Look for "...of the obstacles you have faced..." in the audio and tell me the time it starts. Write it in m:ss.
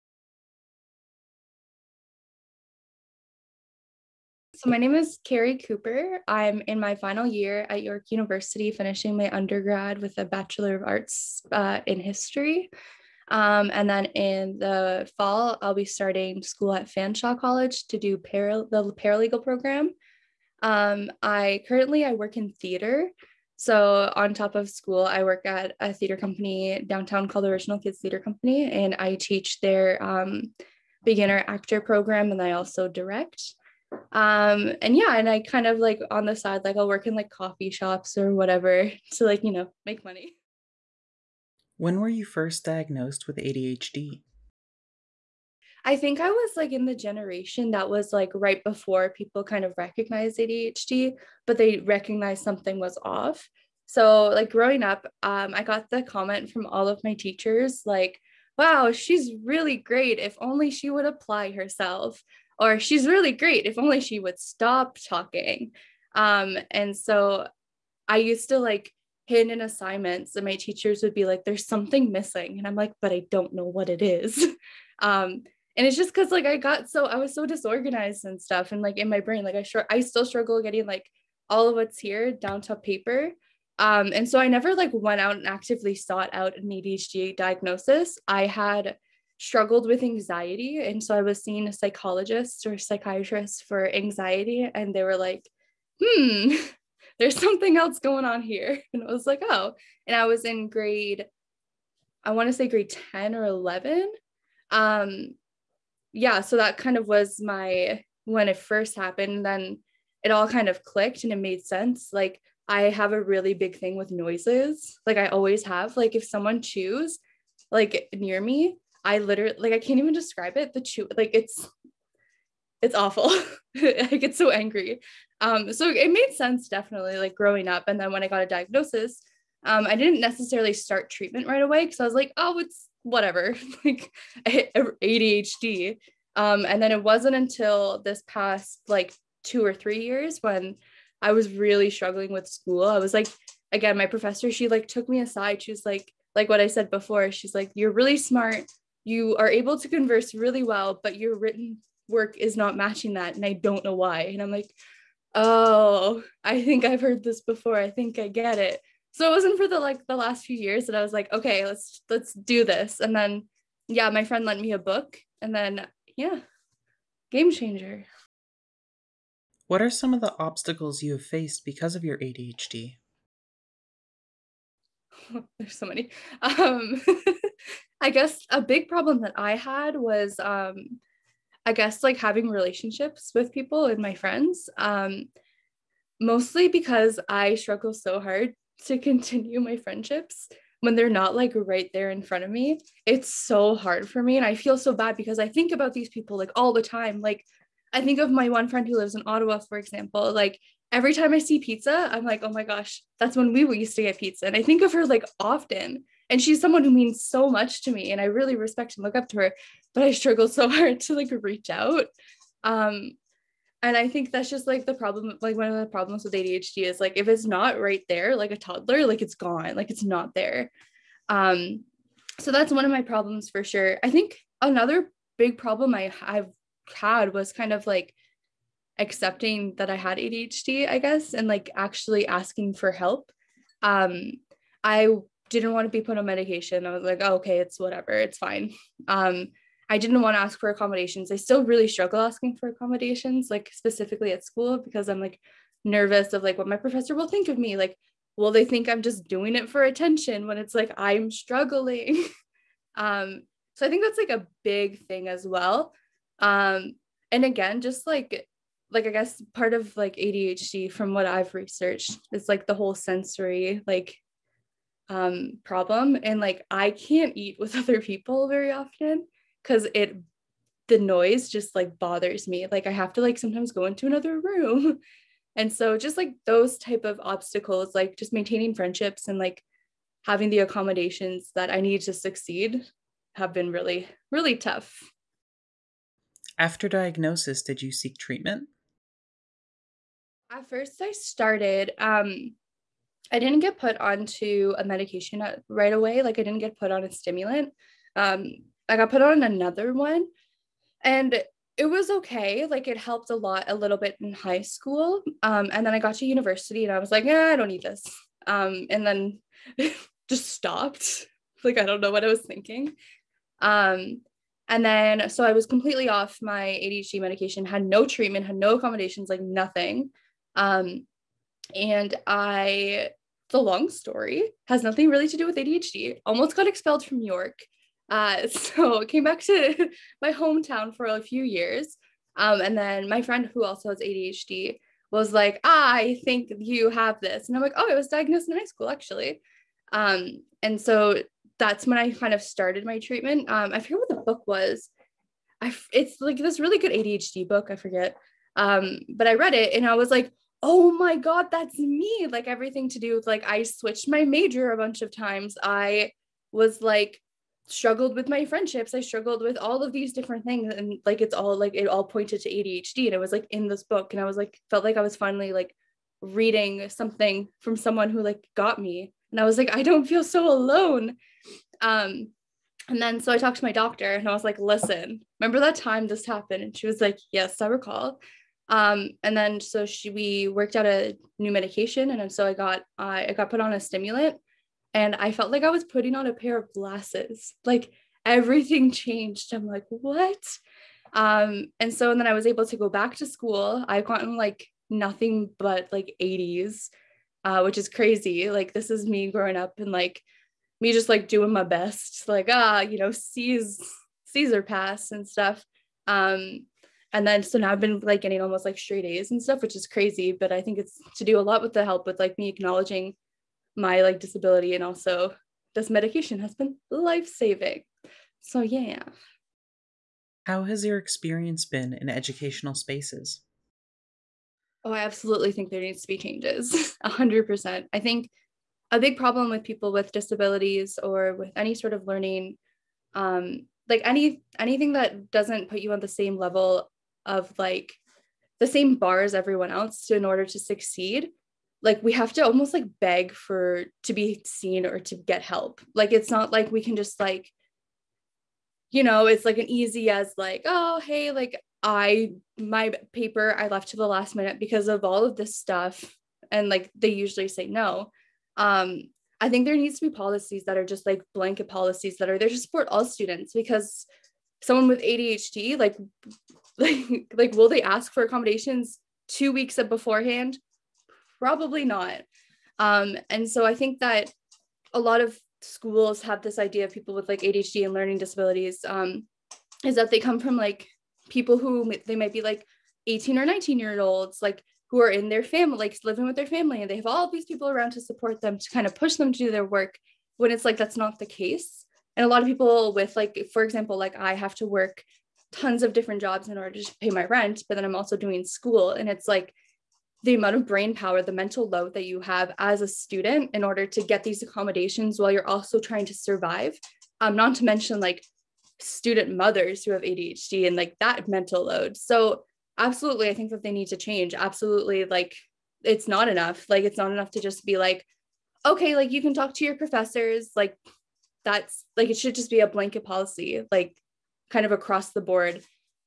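2:50.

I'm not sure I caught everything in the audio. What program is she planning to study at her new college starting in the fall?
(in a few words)
Paralegal.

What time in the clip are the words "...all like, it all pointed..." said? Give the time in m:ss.
6:01.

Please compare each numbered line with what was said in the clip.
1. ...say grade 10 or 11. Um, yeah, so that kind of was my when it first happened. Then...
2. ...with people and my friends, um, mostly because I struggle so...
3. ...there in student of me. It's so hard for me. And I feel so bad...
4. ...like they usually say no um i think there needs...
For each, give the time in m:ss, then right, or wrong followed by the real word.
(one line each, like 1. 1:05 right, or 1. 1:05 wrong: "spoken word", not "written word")
1. 1:42 right
2. 3:03 right
3. 3:11 wrong: "front", not "student"
4. 7:36 right.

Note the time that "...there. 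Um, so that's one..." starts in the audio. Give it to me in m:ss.
3:40.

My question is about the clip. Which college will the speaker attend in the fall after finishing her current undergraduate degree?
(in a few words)
Fanshawe College.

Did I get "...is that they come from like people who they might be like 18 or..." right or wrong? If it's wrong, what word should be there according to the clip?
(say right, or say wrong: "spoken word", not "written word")
right.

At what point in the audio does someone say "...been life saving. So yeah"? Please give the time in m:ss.
6:56.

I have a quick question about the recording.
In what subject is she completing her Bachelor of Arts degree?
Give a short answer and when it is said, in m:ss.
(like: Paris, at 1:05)
History, at 0:12.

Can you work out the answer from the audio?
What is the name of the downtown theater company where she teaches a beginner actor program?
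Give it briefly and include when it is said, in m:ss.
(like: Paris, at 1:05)
Original Kids Theater Company, at 0:27.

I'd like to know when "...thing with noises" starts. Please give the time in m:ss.
1:53.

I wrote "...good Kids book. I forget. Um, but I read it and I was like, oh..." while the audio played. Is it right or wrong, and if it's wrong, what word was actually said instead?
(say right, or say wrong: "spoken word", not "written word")
wrong: "ADHD", not "Kids".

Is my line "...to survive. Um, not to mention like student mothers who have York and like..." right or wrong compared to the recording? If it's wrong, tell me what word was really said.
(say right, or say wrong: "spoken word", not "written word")
wrong: "ADHD", not "York".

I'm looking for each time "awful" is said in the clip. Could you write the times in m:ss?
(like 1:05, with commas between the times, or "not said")
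2:02.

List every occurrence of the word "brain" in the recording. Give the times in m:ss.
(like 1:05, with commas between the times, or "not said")
1:19, 8:20.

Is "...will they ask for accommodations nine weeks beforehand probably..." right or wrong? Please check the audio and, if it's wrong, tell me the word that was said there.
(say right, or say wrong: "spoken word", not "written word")
wrong: "two", not "nine".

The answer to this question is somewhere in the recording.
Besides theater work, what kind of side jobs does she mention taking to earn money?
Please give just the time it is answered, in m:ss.
0:37.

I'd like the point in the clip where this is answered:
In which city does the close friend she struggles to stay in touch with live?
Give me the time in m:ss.
3:19.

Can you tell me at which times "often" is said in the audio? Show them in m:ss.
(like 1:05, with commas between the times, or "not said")
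3:25, 4:28.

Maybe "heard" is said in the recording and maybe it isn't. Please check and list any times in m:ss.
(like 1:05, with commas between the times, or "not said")
2:37.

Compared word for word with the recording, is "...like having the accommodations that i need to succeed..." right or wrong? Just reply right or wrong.
right.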